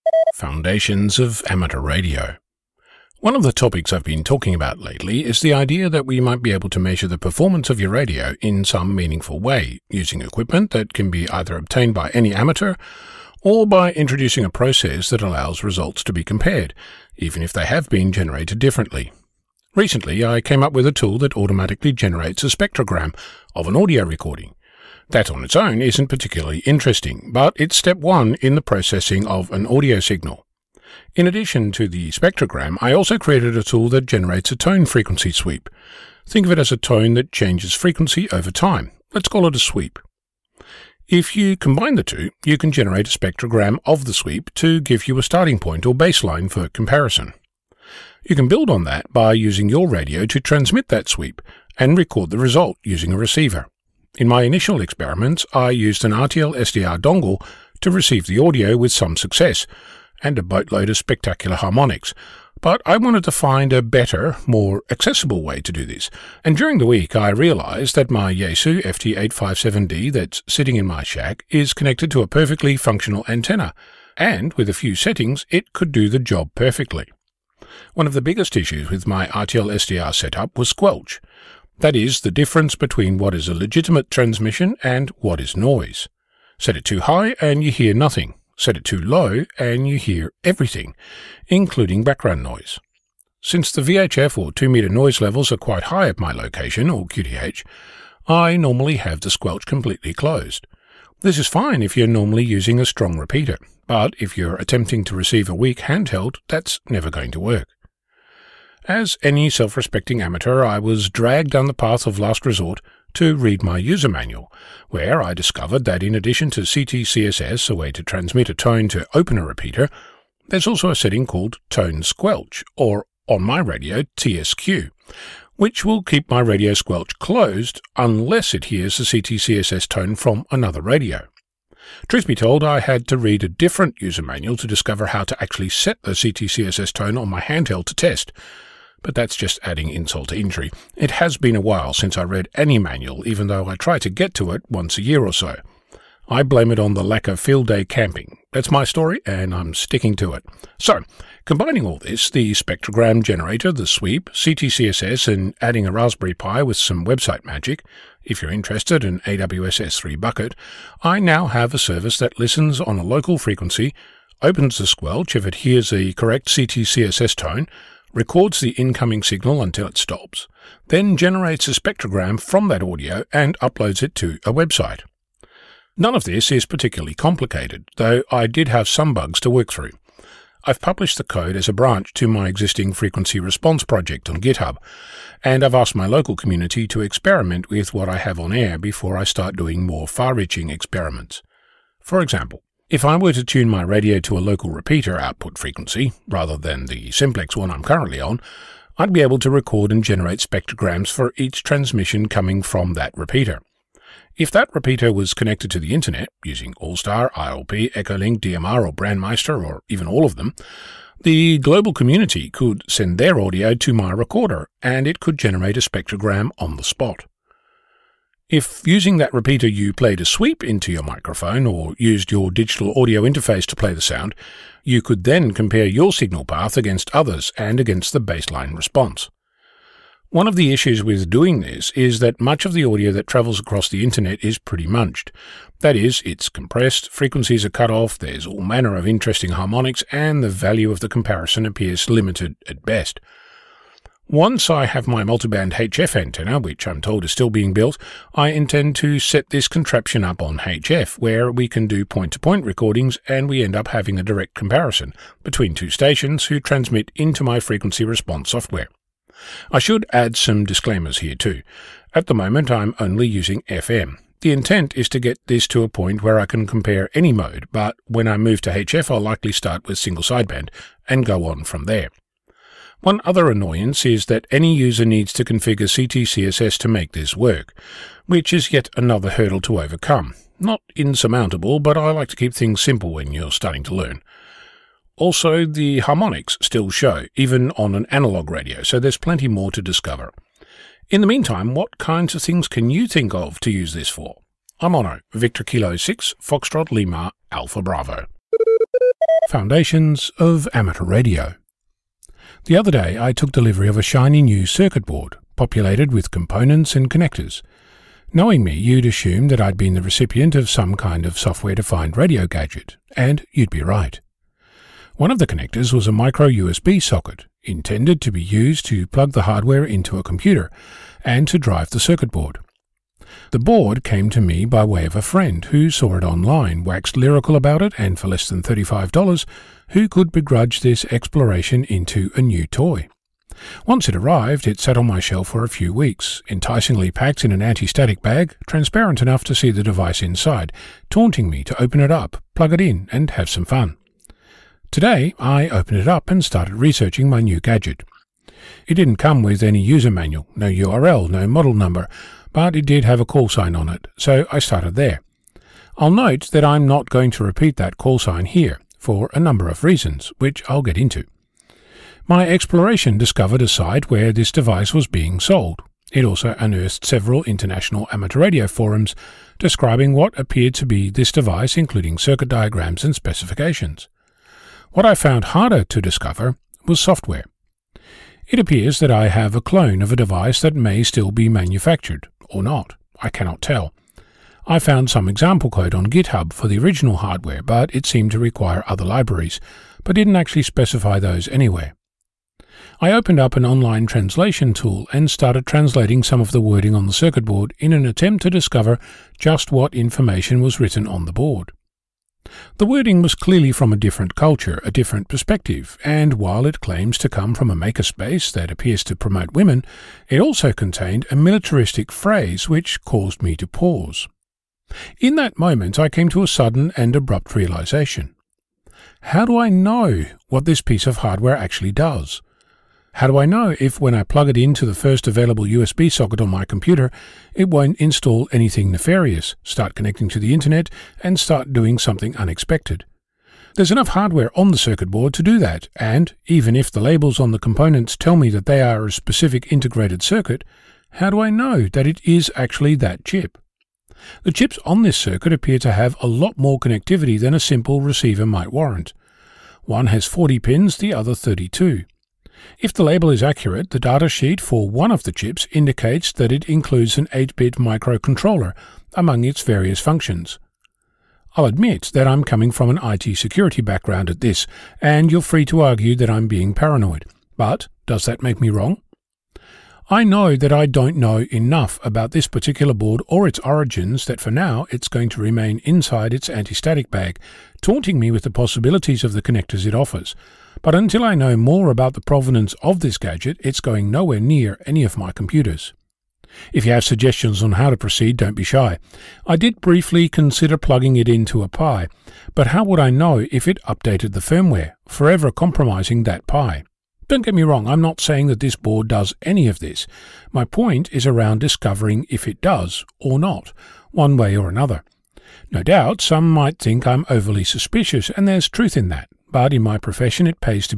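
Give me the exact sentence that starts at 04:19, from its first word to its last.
I should add some disclaimers here too.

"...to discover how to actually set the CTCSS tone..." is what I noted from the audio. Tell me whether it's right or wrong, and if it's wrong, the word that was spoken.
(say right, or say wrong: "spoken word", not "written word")
right.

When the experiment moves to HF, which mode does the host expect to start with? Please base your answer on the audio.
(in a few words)
single sideband.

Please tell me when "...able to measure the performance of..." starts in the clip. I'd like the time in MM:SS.
00:06.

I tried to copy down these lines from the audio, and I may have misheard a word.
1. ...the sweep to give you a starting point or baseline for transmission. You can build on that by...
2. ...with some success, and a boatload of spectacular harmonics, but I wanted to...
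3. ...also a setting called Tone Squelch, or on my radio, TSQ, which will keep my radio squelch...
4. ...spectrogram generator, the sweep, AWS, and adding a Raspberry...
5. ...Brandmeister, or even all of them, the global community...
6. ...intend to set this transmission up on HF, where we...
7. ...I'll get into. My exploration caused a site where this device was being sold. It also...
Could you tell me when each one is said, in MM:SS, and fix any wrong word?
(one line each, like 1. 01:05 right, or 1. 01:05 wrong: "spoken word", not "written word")
1. 00:44 wrong: "comparison", not "transmission"
2. 00:58 right
3. 02:00 right
4. 02:32 wrong: "CTCSS", not "AWS"
5. 03:28 right
6. 04:08 wrong: "contraption", not "transmission"
7. 06:00 wrong: "discovered", not "caused".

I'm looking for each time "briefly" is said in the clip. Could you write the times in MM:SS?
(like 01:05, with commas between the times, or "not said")
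08:09.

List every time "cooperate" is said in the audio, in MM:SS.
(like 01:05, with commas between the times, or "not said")
not said.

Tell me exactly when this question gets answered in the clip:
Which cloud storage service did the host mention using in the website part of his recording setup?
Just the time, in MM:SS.
02:39.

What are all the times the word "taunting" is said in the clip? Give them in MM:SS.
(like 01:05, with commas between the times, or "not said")
05:41, 07:57.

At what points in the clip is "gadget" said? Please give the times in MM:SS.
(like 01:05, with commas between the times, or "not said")
05:12, 05:47, 08:03.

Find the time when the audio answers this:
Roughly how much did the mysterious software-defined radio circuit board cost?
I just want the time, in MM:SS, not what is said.
05:28.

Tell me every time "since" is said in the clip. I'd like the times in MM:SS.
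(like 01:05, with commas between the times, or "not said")
01:33, 02:21.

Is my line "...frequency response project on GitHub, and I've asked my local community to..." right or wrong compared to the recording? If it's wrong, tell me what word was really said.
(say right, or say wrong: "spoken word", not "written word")
right.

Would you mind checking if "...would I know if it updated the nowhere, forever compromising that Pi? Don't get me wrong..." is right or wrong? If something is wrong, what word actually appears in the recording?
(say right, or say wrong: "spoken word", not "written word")
wrong: "firmware", not "nowhere".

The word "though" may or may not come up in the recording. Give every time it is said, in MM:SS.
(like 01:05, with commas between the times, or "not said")
02:23, 02:57.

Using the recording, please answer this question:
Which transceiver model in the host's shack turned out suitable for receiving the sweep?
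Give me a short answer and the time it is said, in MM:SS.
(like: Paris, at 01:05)
Yaesu FT857D, at 01:08.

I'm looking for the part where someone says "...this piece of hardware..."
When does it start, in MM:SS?
07:00.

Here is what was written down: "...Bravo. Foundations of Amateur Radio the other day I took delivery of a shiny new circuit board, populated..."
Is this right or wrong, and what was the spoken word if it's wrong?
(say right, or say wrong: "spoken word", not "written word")
right.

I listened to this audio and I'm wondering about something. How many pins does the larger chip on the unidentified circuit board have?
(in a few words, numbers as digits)
40.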